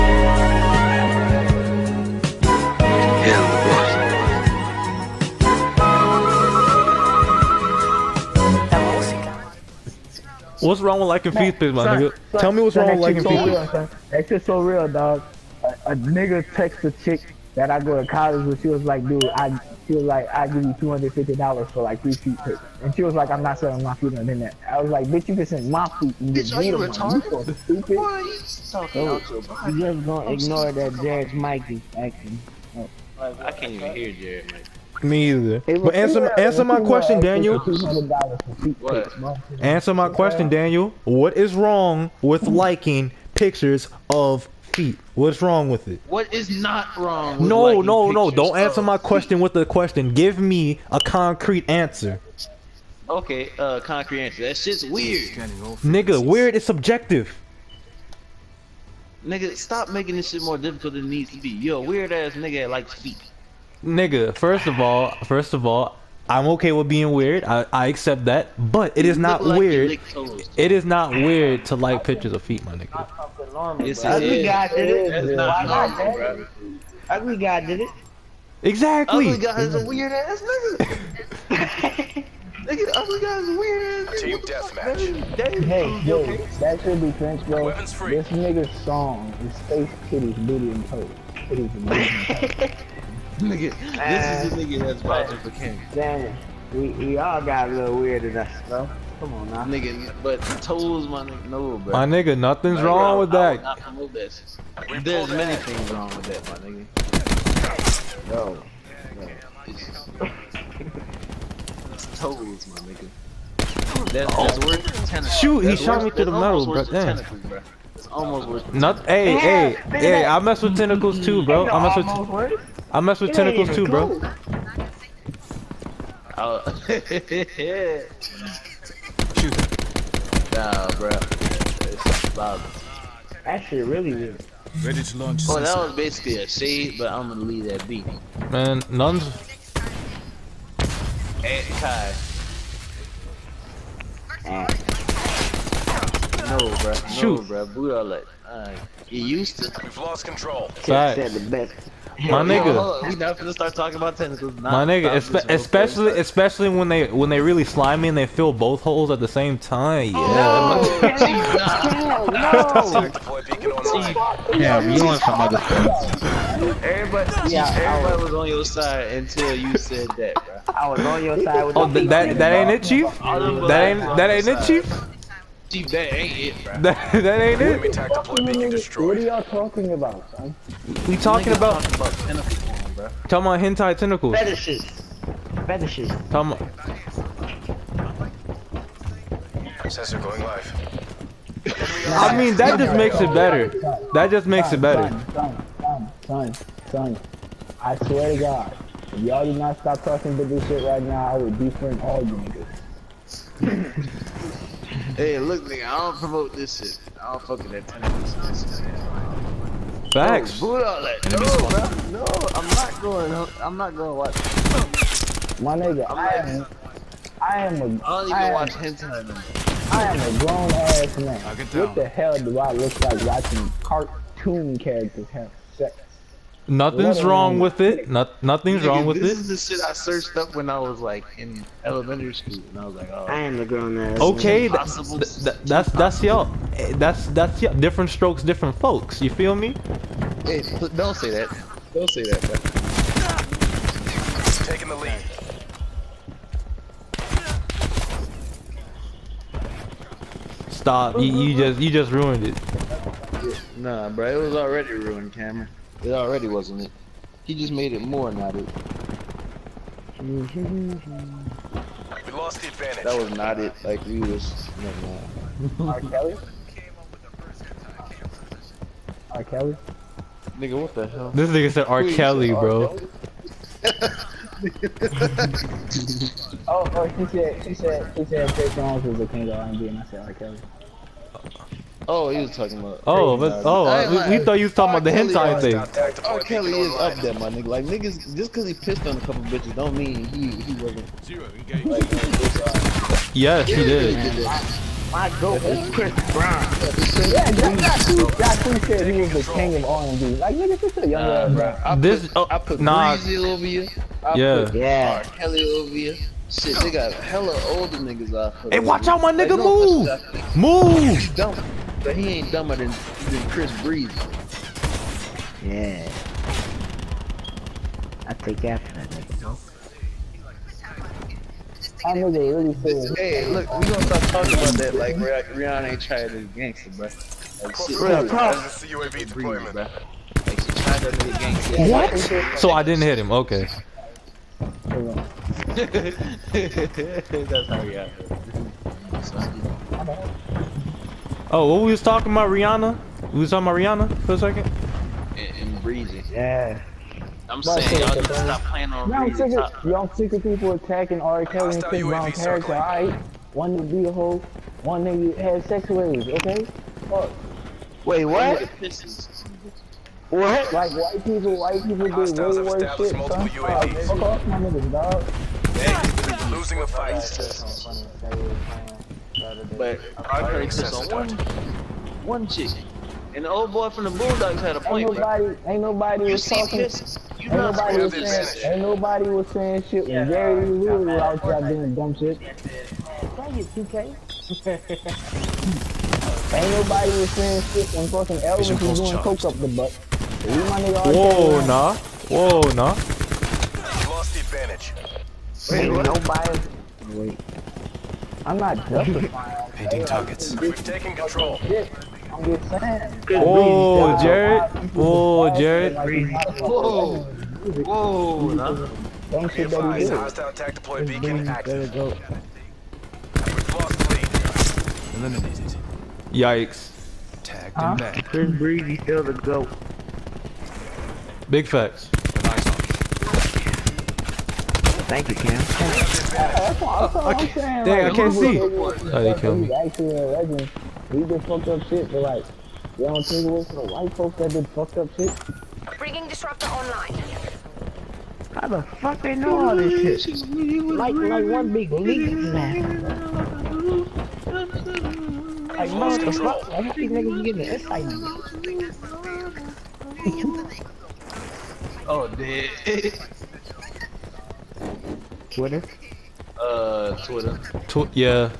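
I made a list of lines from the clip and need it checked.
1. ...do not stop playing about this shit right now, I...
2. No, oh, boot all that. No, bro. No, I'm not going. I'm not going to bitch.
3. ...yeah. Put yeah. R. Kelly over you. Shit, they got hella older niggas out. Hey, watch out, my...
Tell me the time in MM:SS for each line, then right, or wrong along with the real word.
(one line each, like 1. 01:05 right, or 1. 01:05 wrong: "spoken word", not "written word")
1. 03:19 wrong: "talking", not "playing"
2. 03:30 wrong: "watch", not "bitch"
3. 05:04 right.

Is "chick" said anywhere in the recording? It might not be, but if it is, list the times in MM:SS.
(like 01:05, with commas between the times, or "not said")
00:16, 06:12.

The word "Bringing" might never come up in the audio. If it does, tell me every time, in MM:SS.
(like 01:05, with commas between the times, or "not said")
07:15.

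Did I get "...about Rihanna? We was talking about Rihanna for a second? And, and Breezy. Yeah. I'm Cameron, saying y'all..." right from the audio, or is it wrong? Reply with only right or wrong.
wrong.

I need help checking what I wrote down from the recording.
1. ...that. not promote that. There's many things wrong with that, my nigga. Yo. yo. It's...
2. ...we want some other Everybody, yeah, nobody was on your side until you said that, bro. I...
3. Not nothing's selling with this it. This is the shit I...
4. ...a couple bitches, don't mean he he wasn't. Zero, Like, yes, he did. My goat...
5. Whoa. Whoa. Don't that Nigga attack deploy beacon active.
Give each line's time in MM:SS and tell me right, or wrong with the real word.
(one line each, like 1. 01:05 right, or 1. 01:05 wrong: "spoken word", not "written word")
1. 01:43 right
2. 02:44 wrong: "everybody", not "nobody"
3. 03:48 wrong: "wrong", not "selling"
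4. 04:49 right
5. 06:46 wrong: "Hostile", not "Nigga".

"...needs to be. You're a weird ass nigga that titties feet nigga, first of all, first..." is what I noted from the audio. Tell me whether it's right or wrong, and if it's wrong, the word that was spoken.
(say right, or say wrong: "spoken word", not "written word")
wrong: "likes", not "titties".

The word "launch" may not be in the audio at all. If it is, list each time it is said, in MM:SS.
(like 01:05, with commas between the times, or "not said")
02:15.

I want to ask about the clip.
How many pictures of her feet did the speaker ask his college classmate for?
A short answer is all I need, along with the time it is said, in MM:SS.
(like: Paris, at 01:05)
3, at 00:22.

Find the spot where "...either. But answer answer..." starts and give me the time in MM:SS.
00:35.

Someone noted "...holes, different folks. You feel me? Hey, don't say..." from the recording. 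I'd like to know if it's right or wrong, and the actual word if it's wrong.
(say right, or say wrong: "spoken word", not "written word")
wrong: "strokes", not "holes".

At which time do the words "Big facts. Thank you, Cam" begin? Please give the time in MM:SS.
07:01.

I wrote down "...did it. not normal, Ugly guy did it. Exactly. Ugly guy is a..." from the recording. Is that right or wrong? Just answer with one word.
right.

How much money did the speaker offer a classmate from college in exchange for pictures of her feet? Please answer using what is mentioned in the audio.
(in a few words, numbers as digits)
$250.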